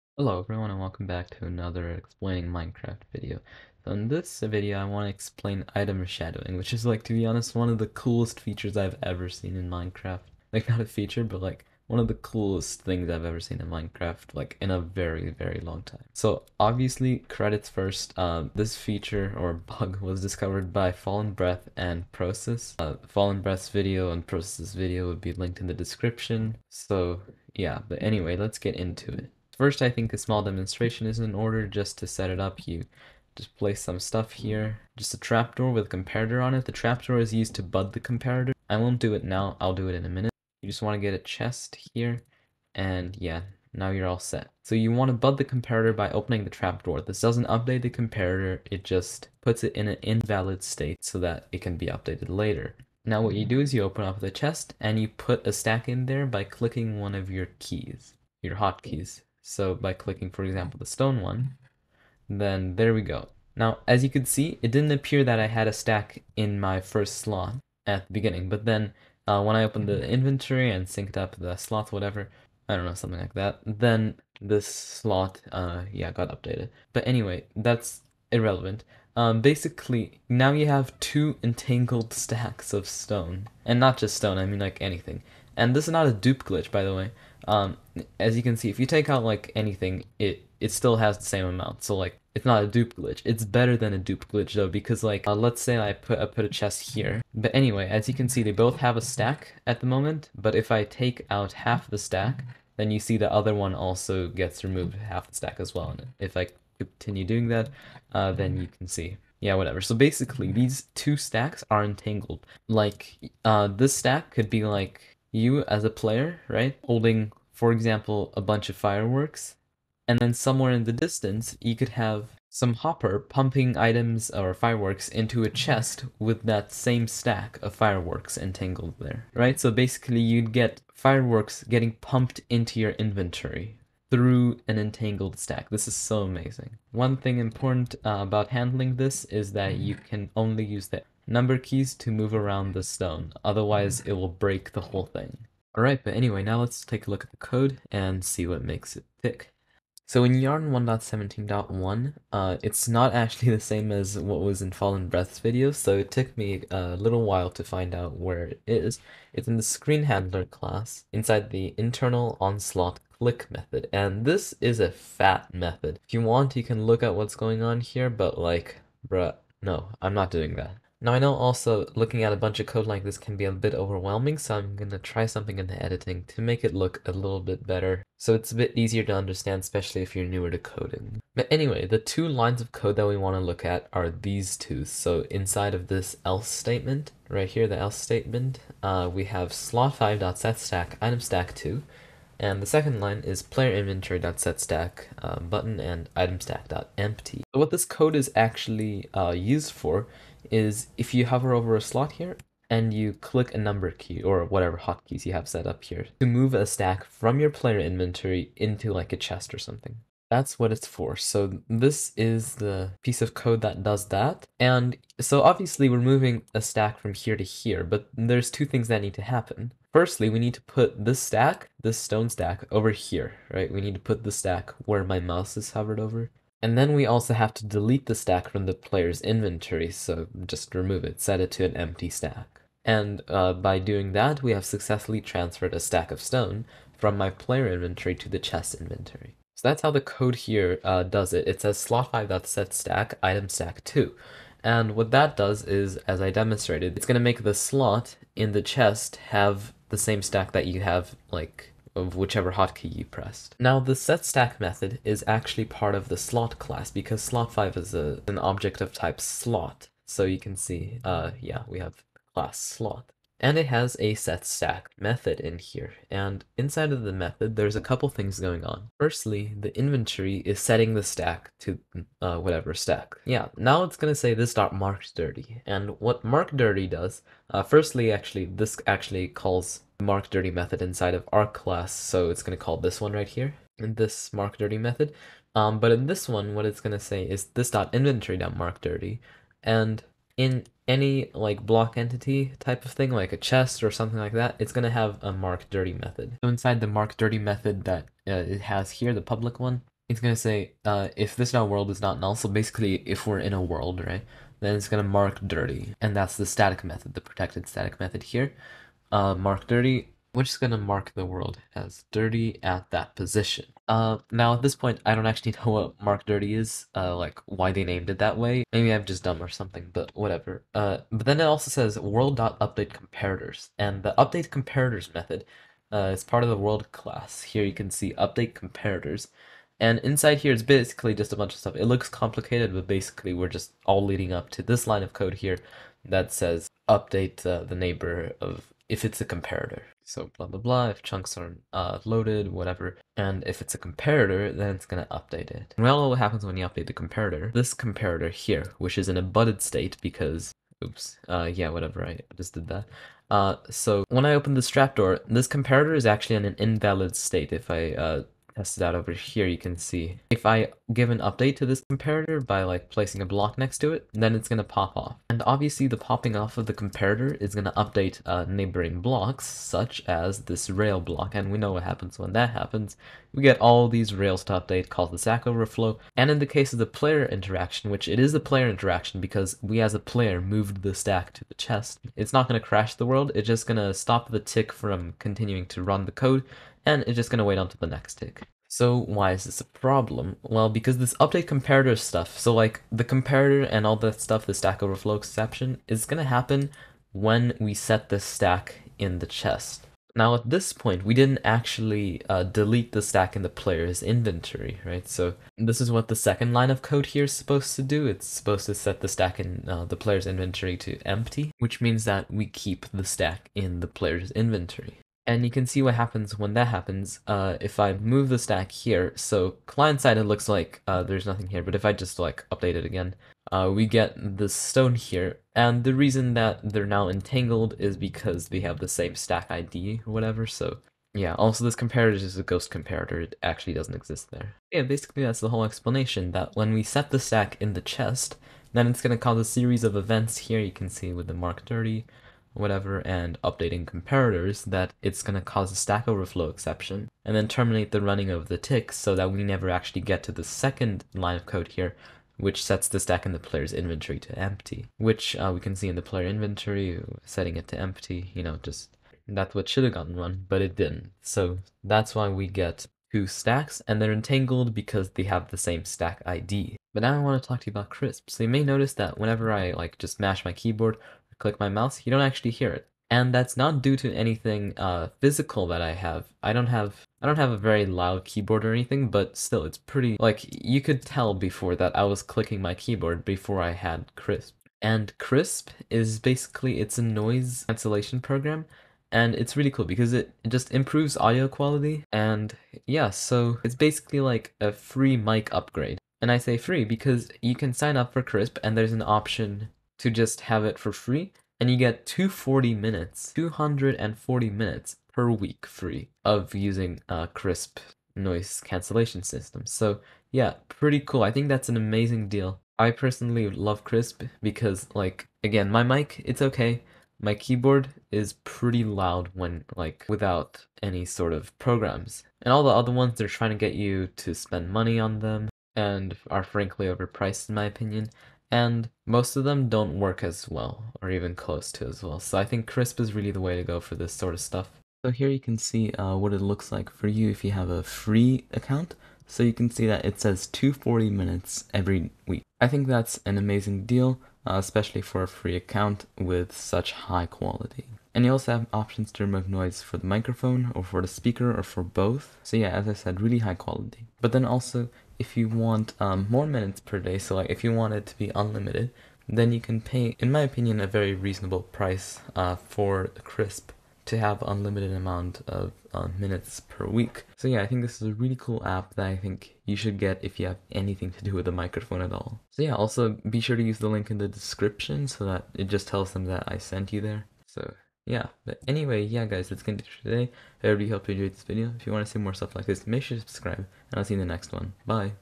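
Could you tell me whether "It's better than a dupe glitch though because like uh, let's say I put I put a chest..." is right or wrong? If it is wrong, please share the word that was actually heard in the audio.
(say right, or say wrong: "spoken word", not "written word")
right.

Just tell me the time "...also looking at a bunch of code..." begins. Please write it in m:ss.
2:51.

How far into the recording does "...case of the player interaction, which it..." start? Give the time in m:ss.
6:16.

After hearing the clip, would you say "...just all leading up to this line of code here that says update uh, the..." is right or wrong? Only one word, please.
right.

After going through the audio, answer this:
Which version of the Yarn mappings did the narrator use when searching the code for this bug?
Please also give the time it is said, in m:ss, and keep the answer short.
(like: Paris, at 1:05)
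1.17.1, at 2:30.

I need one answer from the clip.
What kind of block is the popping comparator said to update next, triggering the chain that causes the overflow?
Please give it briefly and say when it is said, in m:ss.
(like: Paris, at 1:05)
Rail, at 6:10.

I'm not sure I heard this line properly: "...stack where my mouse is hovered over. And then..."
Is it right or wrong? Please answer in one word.
right.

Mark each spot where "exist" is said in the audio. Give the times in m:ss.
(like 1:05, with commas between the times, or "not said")
7:13.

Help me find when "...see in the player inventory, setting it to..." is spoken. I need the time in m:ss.
7:35.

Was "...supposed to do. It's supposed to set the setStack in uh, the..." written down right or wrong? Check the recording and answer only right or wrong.
wrong.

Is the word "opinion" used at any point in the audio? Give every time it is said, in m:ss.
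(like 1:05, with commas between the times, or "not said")
8:47, 9:20.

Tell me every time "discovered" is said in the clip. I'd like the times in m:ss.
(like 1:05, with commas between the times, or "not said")
0:20.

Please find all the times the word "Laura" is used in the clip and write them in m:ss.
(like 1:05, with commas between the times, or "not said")
not said.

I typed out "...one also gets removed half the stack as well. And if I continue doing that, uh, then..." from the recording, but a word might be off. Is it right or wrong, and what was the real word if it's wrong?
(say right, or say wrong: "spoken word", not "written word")
right.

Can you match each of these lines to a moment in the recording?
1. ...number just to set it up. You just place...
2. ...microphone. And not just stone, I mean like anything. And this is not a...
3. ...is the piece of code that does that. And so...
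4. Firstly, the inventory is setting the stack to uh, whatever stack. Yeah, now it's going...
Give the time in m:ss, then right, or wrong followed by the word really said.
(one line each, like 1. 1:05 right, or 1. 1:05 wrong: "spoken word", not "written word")
1. 0:31 wrong: "order", not "number"
2. 1:22 wrong: "stone", not "microphone"
3. 3:32 right
4. 4:28 right.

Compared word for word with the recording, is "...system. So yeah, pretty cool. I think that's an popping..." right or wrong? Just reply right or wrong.
wrong.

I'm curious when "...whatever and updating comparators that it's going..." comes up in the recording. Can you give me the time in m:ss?
7:22.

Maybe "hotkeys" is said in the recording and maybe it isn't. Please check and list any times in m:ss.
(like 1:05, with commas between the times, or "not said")
0:58, 3:24, 4:12.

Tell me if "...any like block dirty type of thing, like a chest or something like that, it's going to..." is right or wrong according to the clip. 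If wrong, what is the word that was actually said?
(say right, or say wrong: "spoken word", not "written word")
wrong: "entity", not "dirty".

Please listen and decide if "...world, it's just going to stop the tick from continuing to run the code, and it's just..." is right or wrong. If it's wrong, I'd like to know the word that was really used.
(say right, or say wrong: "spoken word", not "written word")
right.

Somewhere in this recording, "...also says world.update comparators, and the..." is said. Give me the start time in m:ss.
5:21.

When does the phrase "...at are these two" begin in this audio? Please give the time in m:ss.
3:03.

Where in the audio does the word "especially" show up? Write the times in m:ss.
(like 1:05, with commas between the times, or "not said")
2:59, 9:04.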